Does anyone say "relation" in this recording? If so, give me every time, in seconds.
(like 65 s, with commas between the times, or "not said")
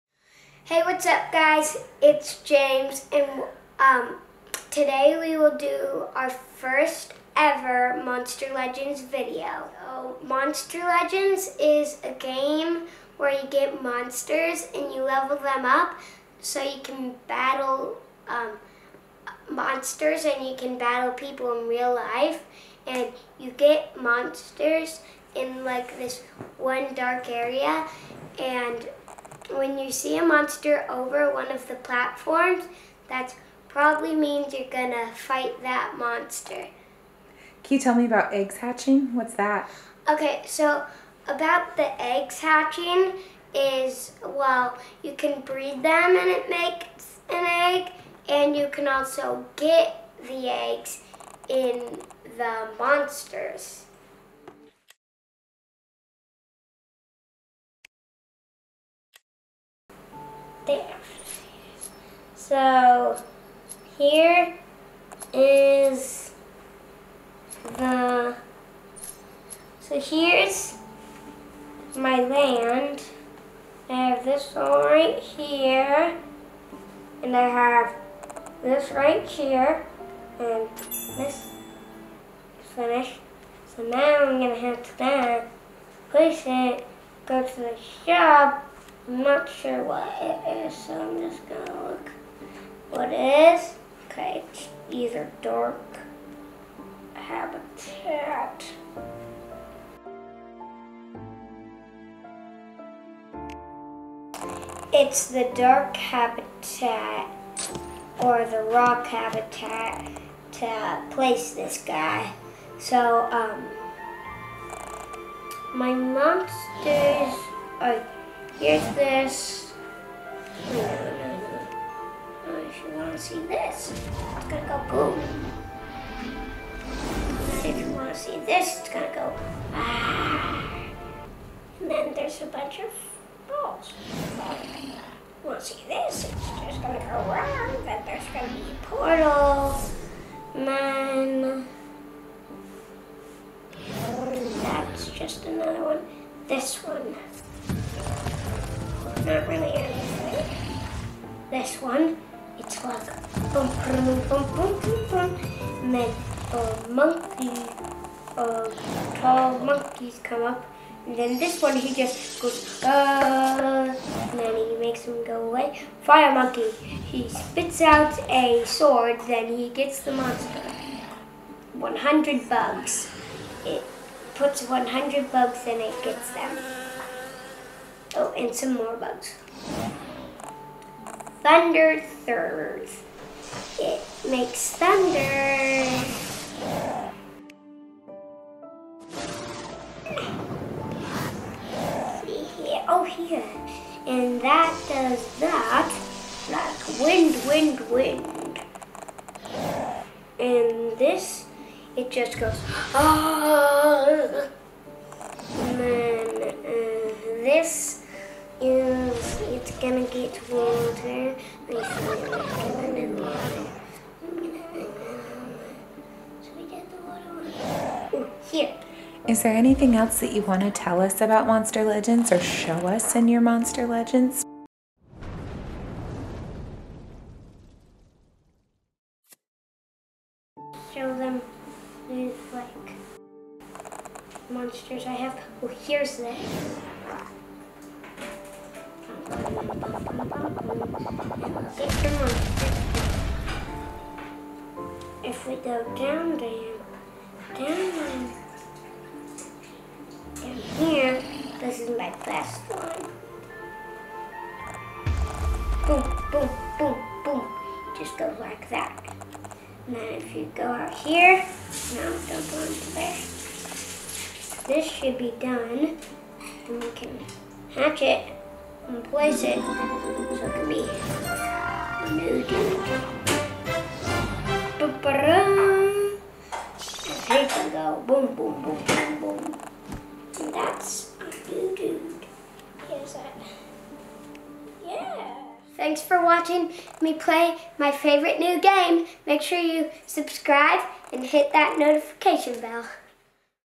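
not said.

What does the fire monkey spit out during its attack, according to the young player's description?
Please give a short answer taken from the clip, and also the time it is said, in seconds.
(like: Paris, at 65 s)
a sword, at 168 s.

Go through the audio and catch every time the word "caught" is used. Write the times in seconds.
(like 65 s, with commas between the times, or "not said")
not said.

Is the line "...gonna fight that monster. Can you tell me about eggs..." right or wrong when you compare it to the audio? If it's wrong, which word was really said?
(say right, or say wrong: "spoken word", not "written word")
right.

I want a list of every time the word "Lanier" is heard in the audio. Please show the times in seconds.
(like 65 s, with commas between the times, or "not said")
not said.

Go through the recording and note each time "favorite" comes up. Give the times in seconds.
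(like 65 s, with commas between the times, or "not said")
287 s.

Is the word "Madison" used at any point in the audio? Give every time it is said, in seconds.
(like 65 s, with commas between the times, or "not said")
not said.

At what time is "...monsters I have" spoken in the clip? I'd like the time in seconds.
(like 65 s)
234 s.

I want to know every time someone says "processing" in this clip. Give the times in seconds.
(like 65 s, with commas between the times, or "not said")
not said.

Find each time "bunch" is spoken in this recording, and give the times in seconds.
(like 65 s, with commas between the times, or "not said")
132 s.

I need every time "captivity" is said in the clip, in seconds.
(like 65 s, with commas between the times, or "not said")
not said.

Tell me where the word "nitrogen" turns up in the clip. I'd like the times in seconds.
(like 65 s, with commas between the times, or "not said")
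not said.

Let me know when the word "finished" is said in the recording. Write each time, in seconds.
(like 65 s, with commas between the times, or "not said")
82 s.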